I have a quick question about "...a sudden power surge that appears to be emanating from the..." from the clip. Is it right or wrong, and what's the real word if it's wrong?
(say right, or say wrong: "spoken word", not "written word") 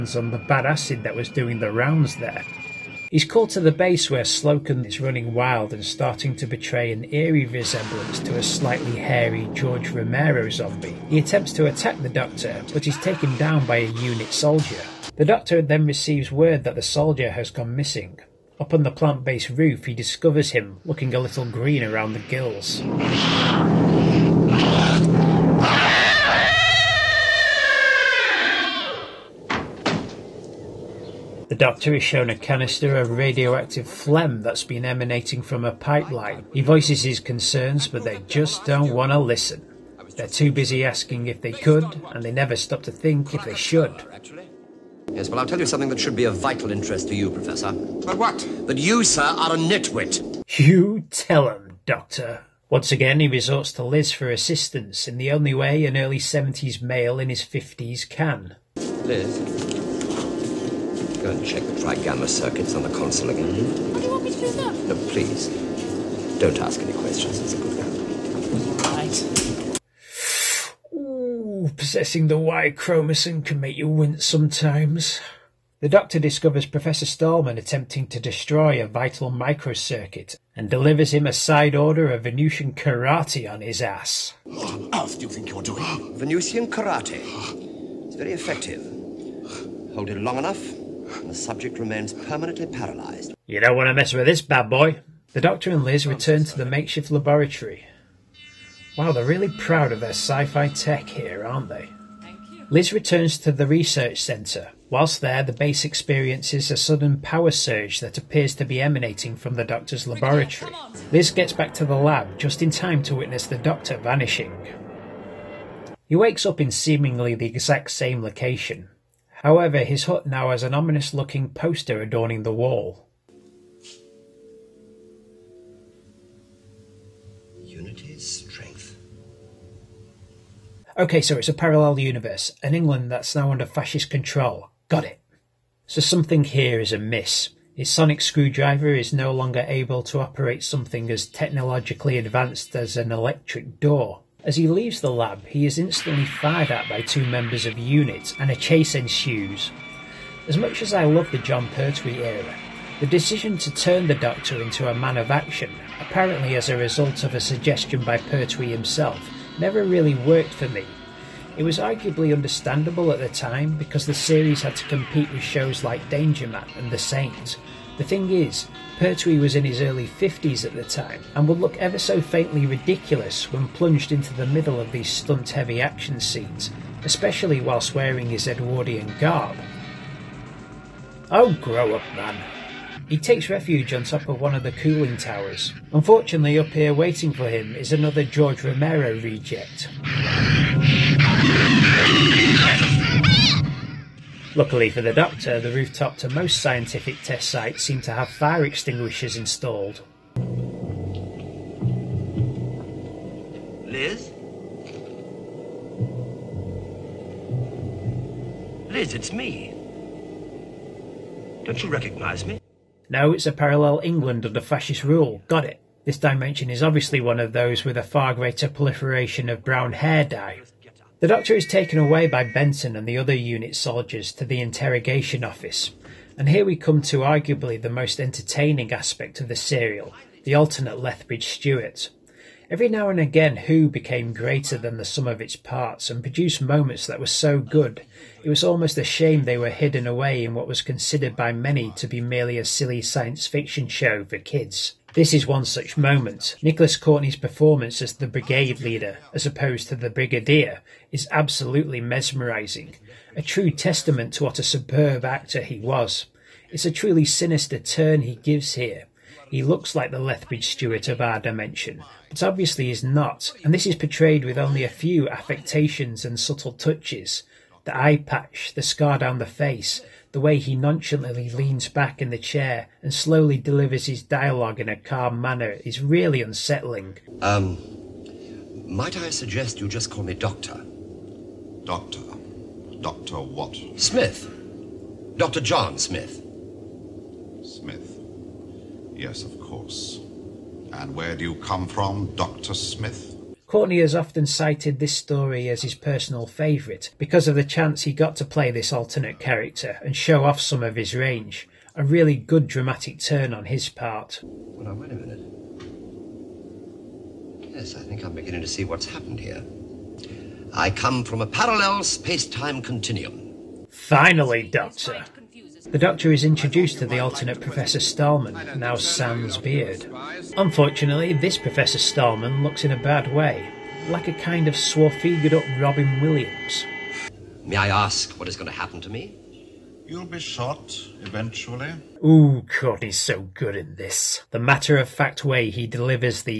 right.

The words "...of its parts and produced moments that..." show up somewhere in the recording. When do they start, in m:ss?
3:55.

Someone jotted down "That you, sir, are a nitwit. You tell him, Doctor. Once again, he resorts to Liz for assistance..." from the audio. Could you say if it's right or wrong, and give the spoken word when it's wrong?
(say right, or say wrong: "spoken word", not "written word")
right.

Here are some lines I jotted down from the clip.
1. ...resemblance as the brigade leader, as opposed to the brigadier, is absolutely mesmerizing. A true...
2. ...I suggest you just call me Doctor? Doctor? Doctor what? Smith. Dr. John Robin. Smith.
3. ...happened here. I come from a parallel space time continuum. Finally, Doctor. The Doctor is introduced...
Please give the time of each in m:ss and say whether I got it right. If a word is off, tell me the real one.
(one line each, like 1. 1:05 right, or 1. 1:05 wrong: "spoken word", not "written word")
1. 4:07 wrong: "performance", not "resemblance"
2. 4:39 wrong: "Smith", not "Robin"
3. 5:09 right.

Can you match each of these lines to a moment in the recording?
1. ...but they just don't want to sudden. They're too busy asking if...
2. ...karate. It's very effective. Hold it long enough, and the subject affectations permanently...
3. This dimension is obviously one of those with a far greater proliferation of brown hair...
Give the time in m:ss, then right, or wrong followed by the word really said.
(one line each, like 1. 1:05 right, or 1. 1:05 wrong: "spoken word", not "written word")
1. 0:37 wrong: "listen", not "sudden"
2. 1:26 wrong: "remains", not "affectations"
3. 3:36 right.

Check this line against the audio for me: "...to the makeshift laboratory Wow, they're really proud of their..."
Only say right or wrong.
right.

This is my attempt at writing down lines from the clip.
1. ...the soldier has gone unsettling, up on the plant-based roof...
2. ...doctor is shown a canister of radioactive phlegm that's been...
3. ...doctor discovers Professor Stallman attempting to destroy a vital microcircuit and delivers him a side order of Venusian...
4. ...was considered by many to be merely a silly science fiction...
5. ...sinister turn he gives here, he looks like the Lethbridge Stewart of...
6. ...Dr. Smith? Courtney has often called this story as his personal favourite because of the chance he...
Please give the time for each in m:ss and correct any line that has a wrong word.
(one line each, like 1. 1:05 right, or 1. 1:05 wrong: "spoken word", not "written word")
1. 0:16 wrong: "missing", not "unsettling"
2. 0:31 right
3. 1:15 right
4. 4:00 right
5. 4:17 right
6. 4:52 wrong: "cited", not "called".